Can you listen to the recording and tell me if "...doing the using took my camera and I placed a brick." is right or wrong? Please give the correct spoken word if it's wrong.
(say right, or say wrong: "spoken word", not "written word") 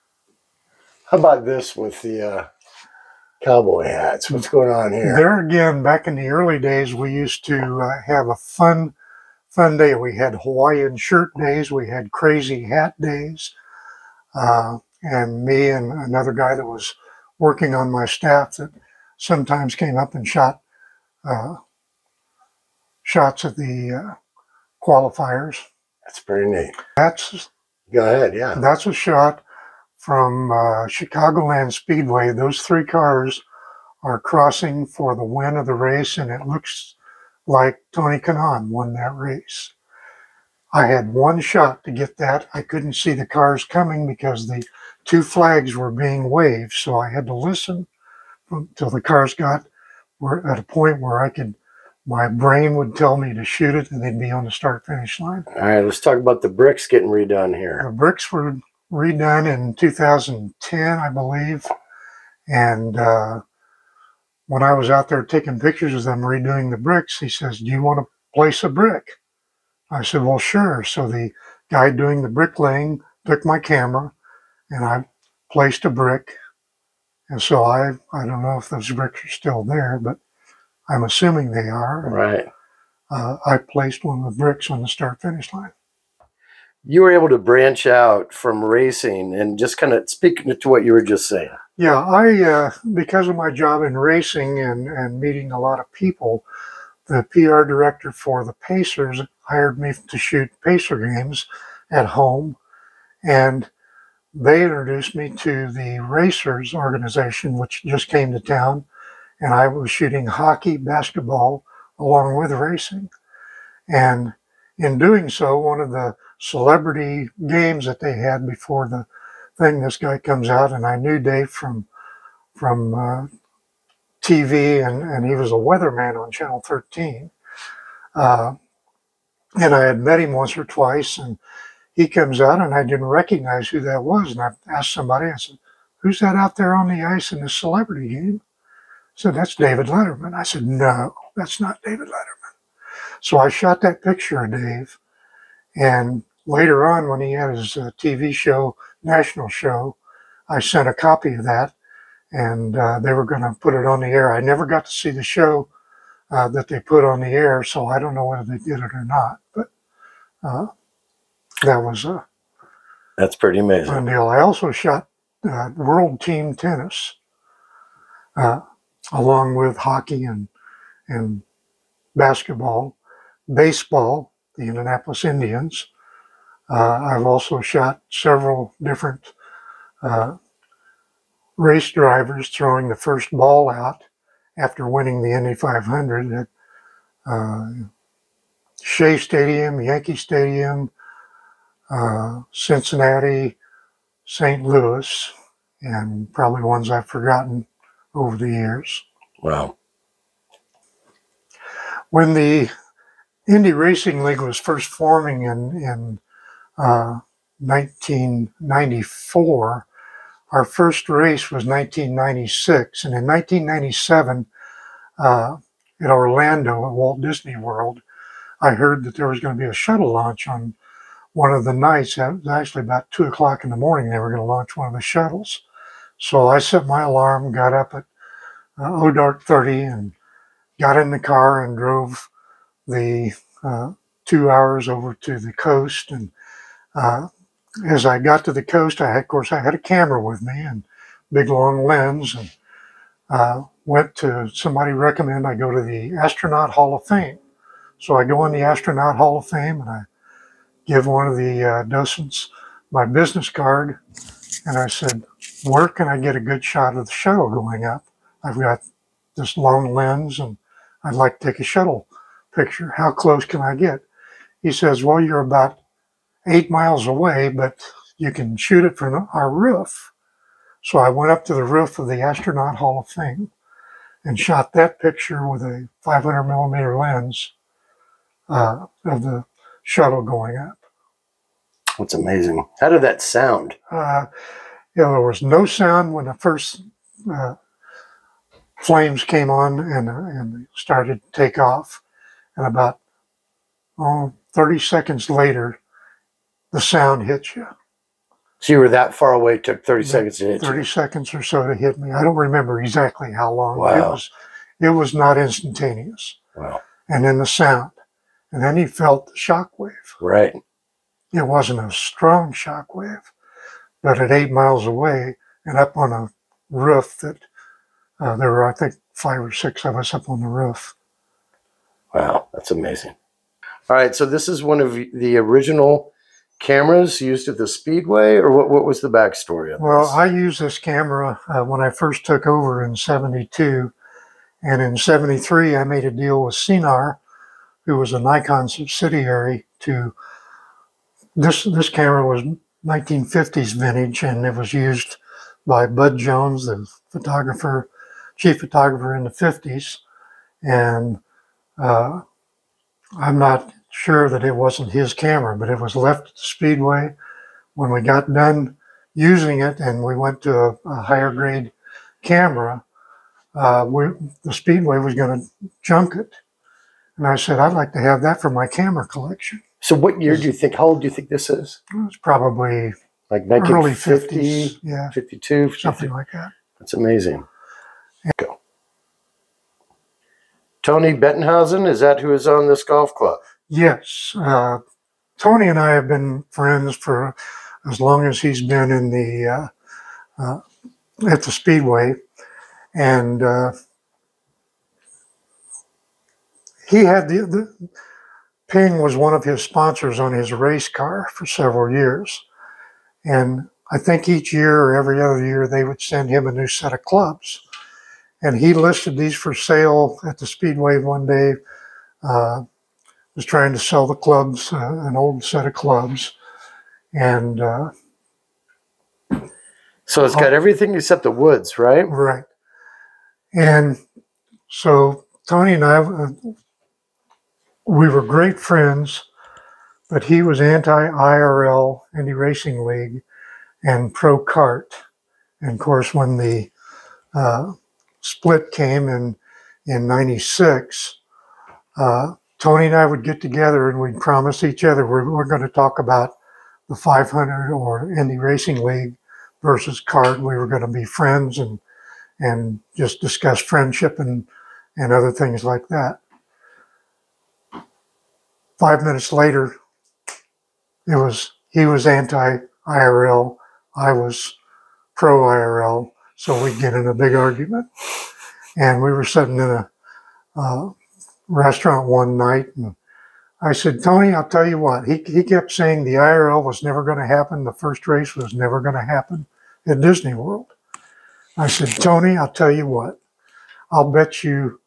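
wrong: "bricklaying", not "using".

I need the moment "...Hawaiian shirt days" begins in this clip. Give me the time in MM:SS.
00:10.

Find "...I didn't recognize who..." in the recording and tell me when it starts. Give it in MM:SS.
02:12.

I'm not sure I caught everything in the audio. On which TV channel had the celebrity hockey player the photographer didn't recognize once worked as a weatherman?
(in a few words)
Channel 13.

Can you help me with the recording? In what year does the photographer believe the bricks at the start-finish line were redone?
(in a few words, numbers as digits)
2010.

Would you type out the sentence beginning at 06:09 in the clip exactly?
So what year do you think, how old do you think this is?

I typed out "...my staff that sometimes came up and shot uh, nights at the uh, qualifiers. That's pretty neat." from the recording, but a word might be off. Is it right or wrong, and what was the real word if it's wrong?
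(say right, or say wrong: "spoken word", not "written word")
wrong: "shots", not "nights".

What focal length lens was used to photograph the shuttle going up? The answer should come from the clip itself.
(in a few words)
500 millimeter.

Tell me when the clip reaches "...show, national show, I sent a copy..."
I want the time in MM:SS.
02:28.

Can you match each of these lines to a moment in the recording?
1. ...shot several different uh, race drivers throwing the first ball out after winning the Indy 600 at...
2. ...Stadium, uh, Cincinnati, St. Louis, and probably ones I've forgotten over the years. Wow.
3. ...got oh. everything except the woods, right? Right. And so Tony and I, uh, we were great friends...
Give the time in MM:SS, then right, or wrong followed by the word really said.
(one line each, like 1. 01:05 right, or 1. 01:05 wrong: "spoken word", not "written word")
1. 02:57 wrong: "500", not "600"
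2. 03:10 right
3. 07:00 right.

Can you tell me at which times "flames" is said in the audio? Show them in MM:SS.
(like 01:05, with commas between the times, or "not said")
04:48.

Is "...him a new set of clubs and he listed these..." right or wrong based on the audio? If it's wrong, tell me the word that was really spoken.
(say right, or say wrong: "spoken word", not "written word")
right.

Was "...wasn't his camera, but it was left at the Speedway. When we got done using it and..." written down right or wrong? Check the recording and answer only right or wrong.
right.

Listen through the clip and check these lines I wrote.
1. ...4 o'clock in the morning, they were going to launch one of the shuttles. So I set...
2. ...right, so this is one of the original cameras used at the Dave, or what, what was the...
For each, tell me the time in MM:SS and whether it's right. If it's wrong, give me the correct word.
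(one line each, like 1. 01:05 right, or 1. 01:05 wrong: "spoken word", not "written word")
1. 03:43 wrong: "2", not "4"
2. 05:23 wrong: "Speedway", not "Dave".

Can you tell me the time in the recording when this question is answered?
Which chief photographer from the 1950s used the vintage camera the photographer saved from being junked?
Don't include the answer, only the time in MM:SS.
05:45.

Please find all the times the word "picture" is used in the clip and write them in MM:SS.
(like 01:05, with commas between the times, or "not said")
01:05, 02:24, 04:22, 04:34.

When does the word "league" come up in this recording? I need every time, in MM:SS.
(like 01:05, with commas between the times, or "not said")
03:24, 07:12, 07:28.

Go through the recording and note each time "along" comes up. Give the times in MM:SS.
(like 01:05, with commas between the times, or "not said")
01:51, 02:49.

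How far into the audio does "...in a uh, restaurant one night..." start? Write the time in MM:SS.
07:49.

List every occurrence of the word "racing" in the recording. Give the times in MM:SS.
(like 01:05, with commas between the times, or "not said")
01:28, 01:33, 01:52, 03:23, 07:12, 07:28.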